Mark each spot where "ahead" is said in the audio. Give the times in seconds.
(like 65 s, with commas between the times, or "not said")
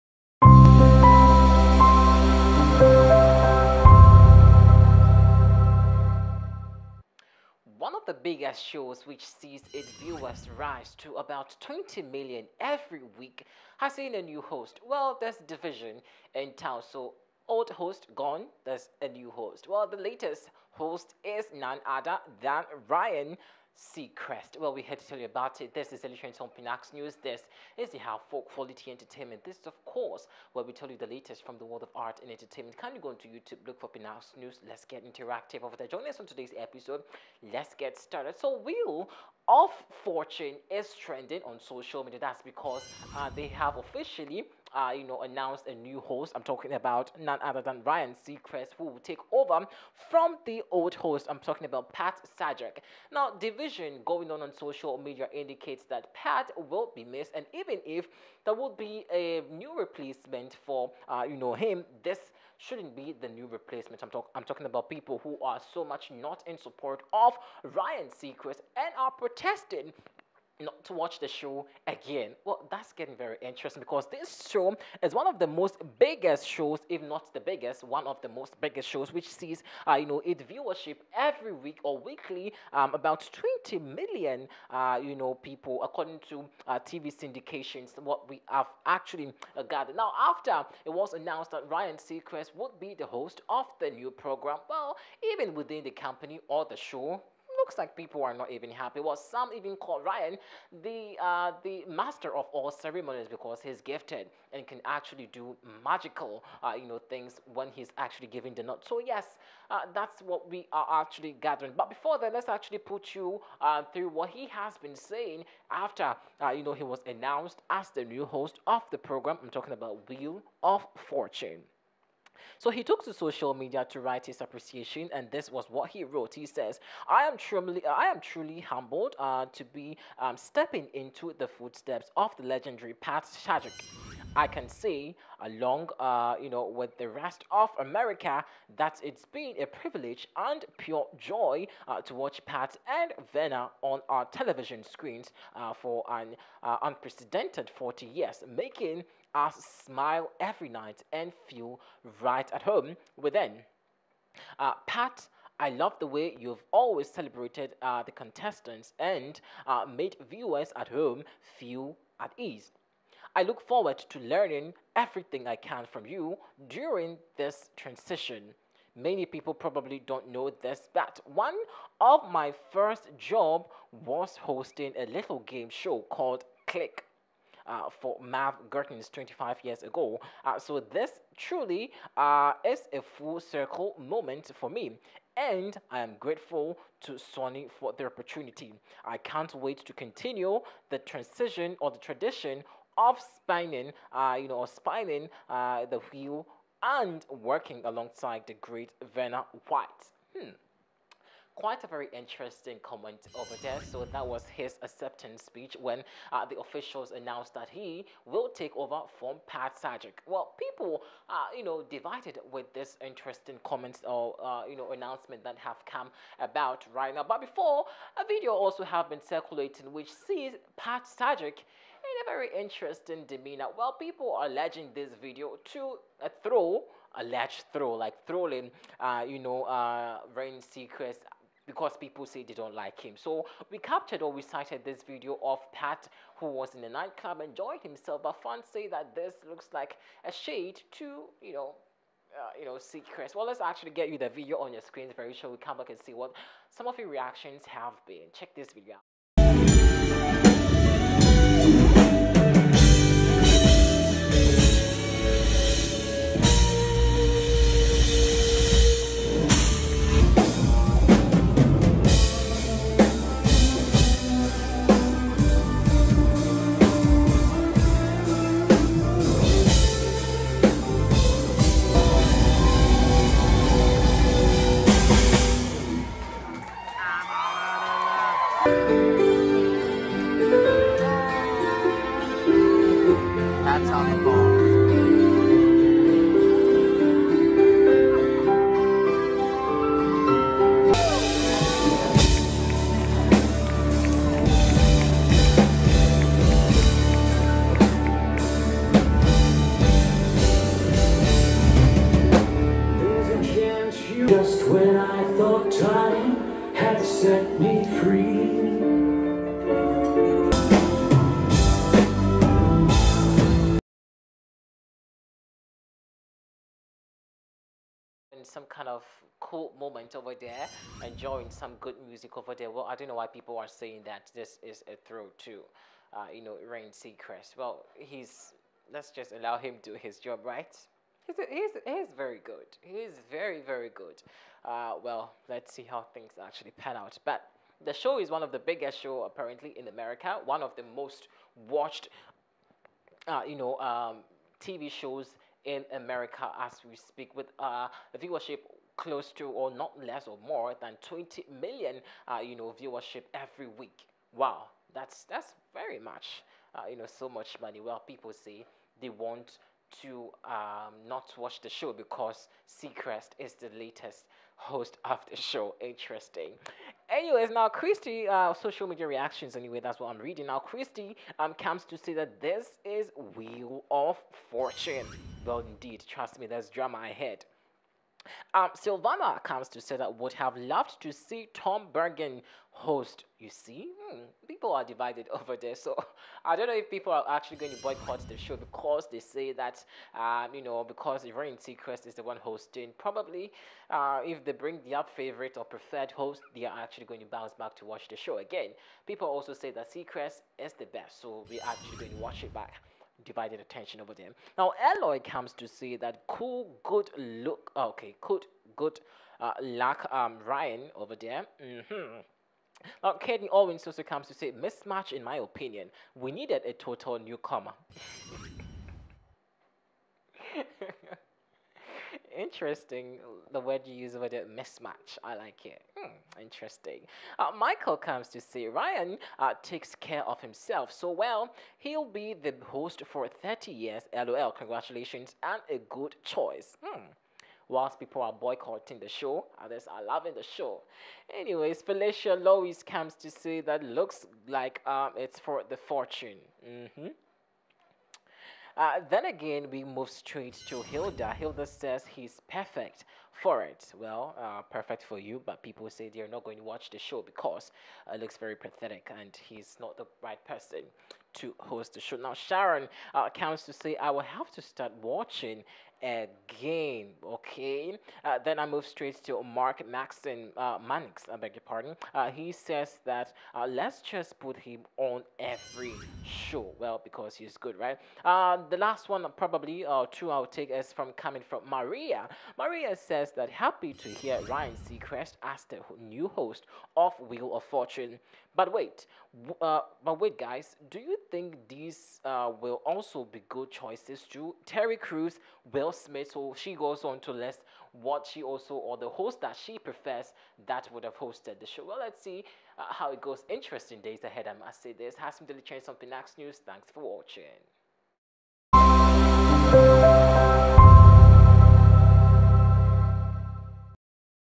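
376 s, 504 s.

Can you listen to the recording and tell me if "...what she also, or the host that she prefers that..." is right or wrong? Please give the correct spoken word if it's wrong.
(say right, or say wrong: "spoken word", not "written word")
right.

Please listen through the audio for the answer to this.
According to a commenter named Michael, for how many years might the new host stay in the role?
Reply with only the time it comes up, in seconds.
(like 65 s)
433 s.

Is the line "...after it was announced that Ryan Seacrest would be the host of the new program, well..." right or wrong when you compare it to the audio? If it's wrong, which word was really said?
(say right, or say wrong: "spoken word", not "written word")
right.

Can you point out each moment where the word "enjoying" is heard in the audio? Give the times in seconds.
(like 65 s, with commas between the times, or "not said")
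237 s, 321 s.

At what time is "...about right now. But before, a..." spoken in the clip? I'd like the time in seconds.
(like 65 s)
216 s.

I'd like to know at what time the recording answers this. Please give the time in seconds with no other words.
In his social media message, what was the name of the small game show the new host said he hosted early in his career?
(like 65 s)
176 s.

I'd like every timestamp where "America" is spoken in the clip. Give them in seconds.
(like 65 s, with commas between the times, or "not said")
137 s, 339 s, 345 s.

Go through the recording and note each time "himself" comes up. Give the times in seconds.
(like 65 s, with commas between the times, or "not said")
237 s, 430 s.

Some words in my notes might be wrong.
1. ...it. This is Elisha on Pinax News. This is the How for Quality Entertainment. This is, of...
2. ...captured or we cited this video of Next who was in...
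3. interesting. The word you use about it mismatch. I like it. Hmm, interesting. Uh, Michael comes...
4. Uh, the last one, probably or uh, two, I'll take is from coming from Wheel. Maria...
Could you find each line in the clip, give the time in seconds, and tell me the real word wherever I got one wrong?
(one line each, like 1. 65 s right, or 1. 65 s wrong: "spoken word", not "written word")
1. 25 s right
2. 233 s wrong: "Pat", not "Next"
3. 422 s right
4. 478 s wrong: "Maria", not "Wheel".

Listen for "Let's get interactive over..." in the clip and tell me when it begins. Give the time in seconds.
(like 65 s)
34 s.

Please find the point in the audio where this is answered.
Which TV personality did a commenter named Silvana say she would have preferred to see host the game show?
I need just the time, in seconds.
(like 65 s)
381 s.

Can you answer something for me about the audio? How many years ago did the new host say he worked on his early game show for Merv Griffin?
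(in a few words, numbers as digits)
25 years.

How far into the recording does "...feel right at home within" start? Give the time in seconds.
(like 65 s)
151 s.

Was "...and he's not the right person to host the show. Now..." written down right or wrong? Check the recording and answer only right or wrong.
right.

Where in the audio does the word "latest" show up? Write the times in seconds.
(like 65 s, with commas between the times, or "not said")
19 s, 31 s, 363 s.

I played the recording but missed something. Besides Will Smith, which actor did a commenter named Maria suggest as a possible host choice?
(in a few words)
Terry Crews.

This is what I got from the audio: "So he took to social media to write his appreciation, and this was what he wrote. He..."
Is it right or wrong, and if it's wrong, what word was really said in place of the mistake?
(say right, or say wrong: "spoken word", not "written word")
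right.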